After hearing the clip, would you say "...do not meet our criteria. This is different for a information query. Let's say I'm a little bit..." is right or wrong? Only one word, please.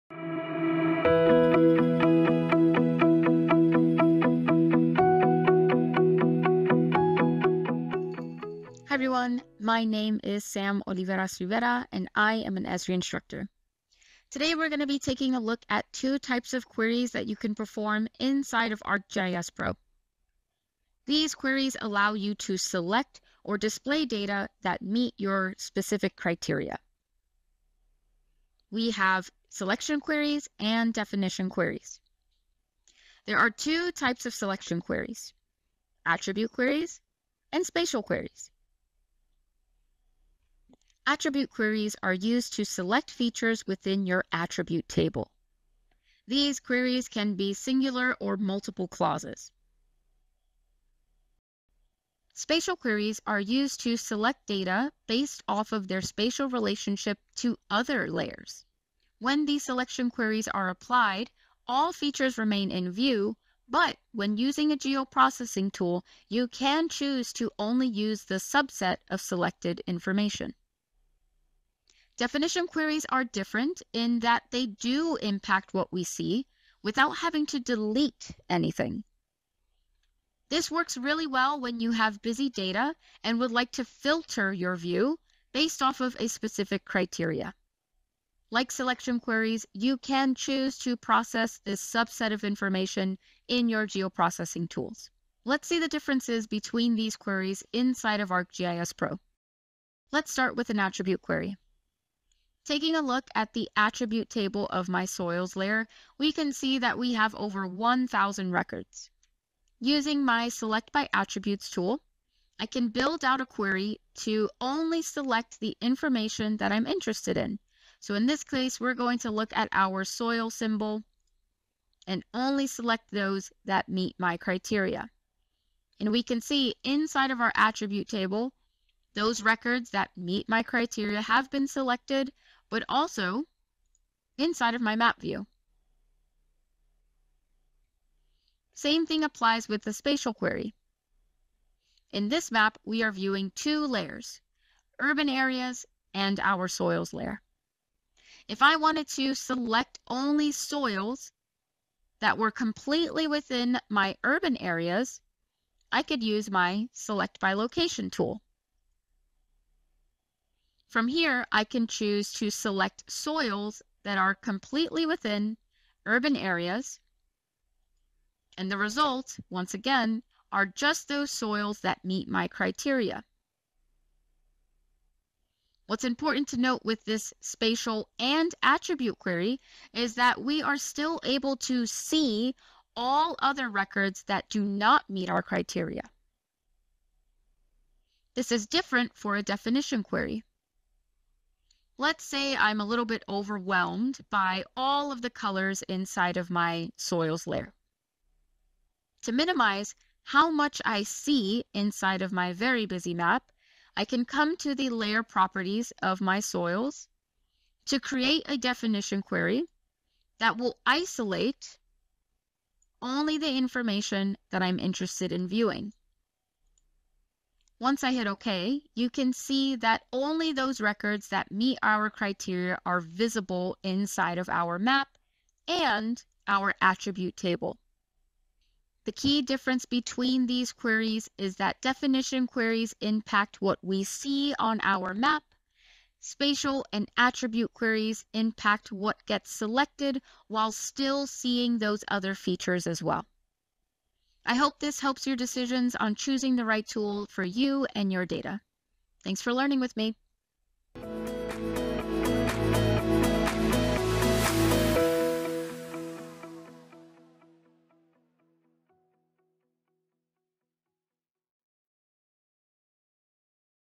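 wrong.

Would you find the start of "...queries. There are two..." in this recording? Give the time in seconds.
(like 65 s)
31 s.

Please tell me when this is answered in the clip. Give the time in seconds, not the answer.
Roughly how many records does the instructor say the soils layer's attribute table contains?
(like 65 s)
107 s.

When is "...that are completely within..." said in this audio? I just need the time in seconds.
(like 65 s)
164 s.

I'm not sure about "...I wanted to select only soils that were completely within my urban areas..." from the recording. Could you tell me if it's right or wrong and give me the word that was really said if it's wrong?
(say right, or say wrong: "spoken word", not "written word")
right.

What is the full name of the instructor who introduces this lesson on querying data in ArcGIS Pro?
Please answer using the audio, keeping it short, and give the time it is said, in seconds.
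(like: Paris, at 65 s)
Sam Oliveras Rivera, at 10 s.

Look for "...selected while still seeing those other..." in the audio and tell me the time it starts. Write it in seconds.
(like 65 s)
239 s.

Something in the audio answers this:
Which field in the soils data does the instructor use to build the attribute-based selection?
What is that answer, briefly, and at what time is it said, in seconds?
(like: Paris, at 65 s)
soil symbol, at 120 s.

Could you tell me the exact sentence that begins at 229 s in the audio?
The key difference between these queries is that definition queries impact what we see on our map.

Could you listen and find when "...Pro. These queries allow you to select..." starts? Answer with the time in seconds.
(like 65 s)
19 s.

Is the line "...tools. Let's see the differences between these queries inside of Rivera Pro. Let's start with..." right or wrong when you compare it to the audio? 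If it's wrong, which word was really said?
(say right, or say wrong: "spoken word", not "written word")
wrong: "ArcGIS", not "Rivera".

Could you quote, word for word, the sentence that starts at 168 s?
And the results, once again, are just those soils that meet my criteria.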